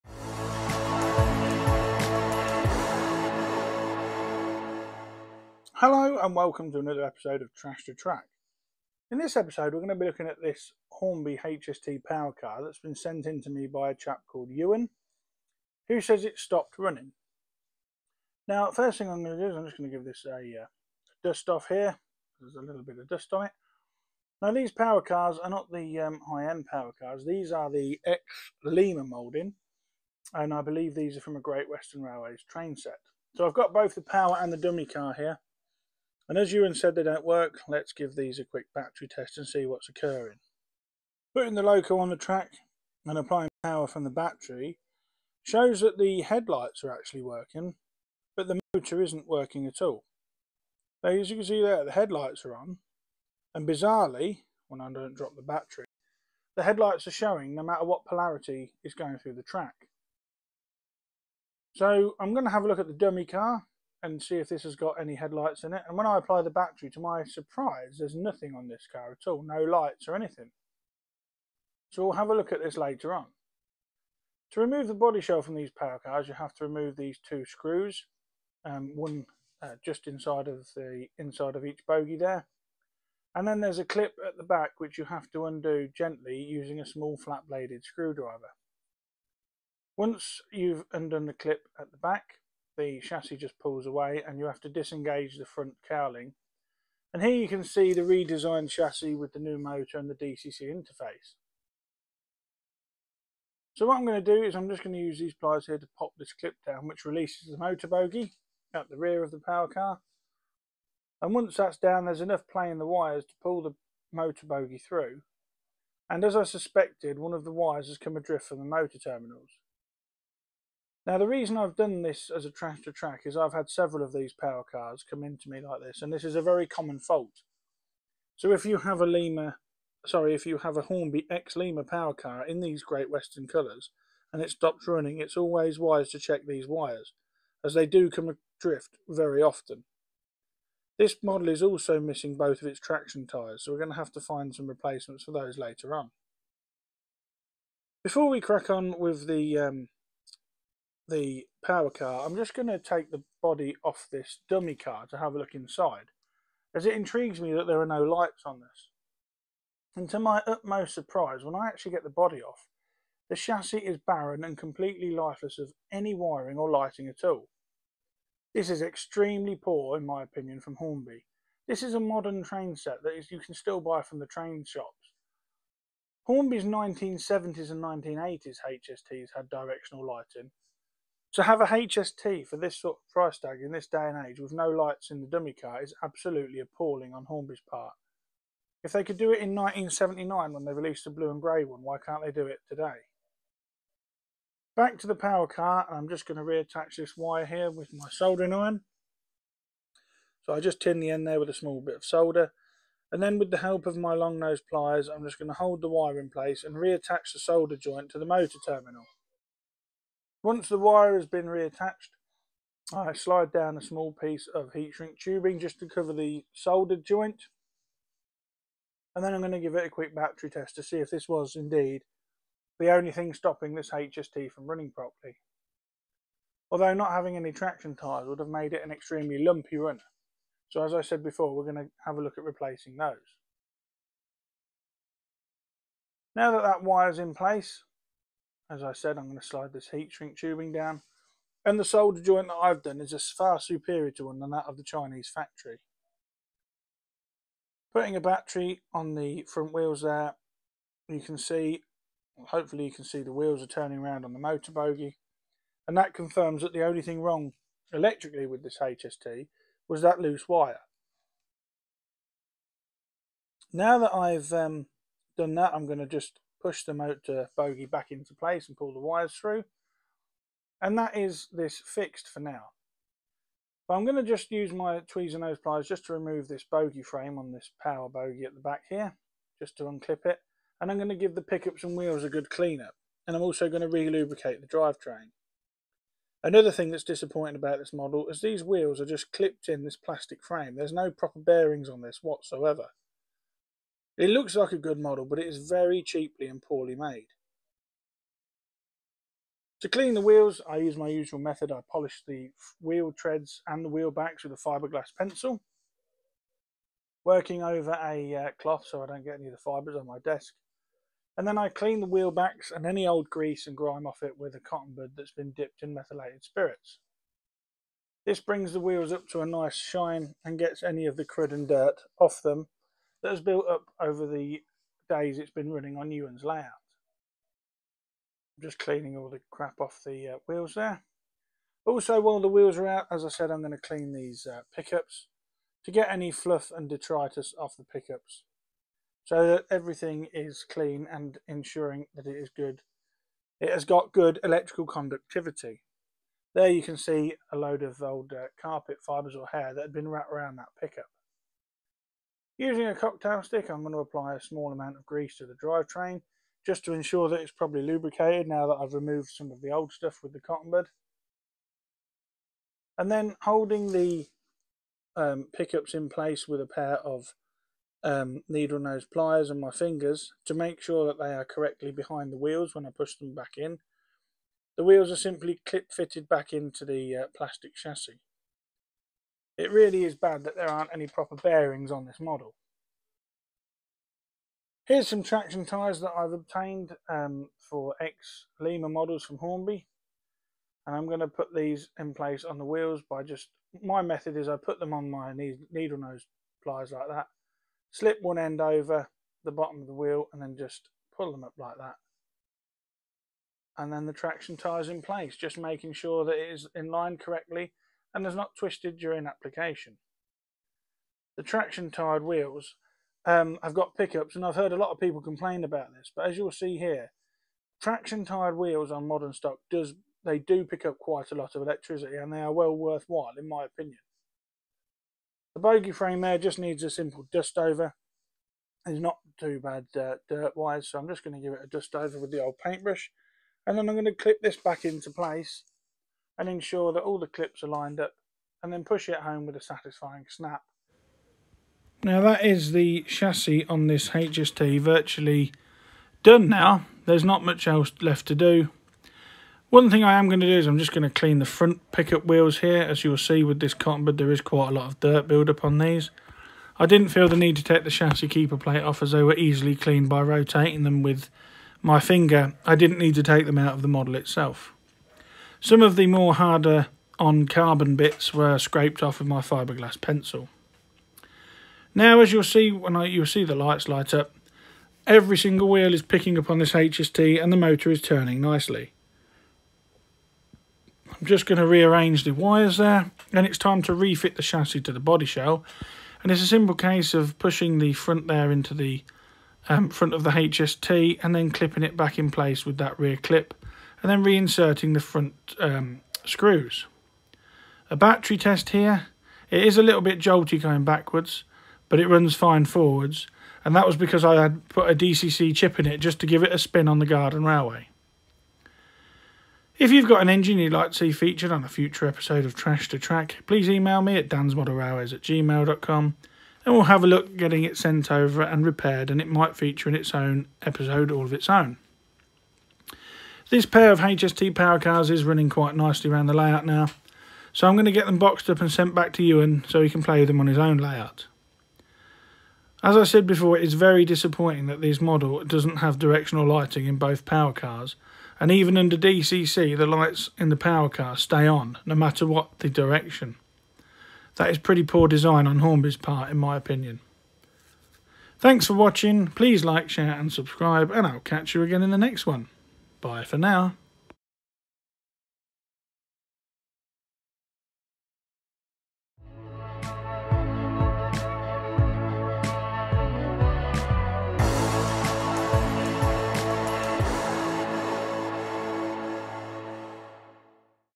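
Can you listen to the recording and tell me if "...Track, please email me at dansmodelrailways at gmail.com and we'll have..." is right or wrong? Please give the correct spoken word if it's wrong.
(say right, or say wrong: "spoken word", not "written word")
right.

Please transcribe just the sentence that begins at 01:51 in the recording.
And once that's down there's enough play in the wires to pull the motor bogie through.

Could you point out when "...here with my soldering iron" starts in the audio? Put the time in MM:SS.
03:17.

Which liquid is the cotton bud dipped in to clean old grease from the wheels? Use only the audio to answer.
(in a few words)
methylated spirits.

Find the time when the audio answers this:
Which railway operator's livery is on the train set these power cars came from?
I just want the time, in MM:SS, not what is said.
00:31.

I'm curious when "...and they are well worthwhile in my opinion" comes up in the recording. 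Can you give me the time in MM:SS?
07:02.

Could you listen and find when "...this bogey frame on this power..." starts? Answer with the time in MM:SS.
04:36.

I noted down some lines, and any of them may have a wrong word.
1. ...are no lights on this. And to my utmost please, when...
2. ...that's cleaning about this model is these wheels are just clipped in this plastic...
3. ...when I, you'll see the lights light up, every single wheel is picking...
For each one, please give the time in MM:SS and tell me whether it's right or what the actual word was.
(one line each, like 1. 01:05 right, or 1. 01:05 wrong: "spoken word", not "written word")
1. 02:37 wrong: "surprise", not "please"
2. 04:46 wrong: "disappointing", not "cleaning"
3. 07:52 right.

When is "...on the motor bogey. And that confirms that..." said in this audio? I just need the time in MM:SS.
04:14.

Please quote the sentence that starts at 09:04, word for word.
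That is pretty poor design on Hornby's part in my opinion.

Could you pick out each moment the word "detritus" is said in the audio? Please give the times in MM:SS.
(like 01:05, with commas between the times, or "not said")
05:36.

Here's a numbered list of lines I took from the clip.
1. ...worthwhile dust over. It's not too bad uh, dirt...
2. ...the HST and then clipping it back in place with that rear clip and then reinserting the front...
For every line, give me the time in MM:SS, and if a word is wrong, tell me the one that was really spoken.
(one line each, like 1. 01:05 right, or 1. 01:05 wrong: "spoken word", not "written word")
1. 07:06 wrong: "simple", not "worthwhile"
2. 08:10 right.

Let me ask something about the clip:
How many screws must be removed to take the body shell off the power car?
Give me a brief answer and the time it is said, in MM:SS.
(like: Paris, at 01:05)
2, at 01:16.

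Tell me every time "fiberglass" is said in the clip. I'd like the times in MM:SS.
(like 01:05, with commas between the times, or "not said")
05:04, 07:49.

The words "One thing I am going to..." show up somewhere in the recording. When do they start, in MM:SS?
07:29.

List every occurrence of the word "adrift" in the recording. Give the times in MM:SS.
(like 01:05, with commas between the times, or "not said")
01:58, 02:18.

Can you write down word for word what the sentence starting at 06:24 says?
Here's some traction tyres that I've obtained um, for ex-Lima models from Hornby.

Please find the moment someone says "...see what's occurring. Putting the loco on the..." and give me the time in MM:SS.
00:39.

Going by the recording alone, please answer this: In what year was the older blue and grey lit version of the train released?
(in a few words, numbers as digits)
1979.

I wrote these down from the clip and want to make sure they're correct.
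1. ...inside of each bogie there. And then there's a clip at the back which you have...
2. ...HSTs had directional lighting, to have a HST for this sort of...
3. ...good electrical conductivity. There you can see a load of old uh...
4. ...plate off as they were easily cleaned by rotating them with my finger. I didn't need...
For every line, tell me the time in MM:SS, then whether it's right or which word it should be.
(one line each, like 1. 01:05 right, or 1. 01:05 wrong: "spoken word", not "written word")
1. 01:21 right
2. 02:58 right
3. 05:44 right
4. 07:38 right.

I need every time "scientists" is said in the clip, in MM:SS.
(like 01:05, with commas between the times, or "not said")
not said.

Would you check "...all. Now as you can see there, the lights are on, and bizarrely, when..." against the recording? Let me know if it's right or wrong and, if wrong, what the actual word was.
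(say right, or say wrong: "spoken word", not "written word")
wrong: "headlights", not "lights".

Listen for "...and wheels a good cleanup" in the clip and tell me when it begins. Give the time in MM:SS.
04:41.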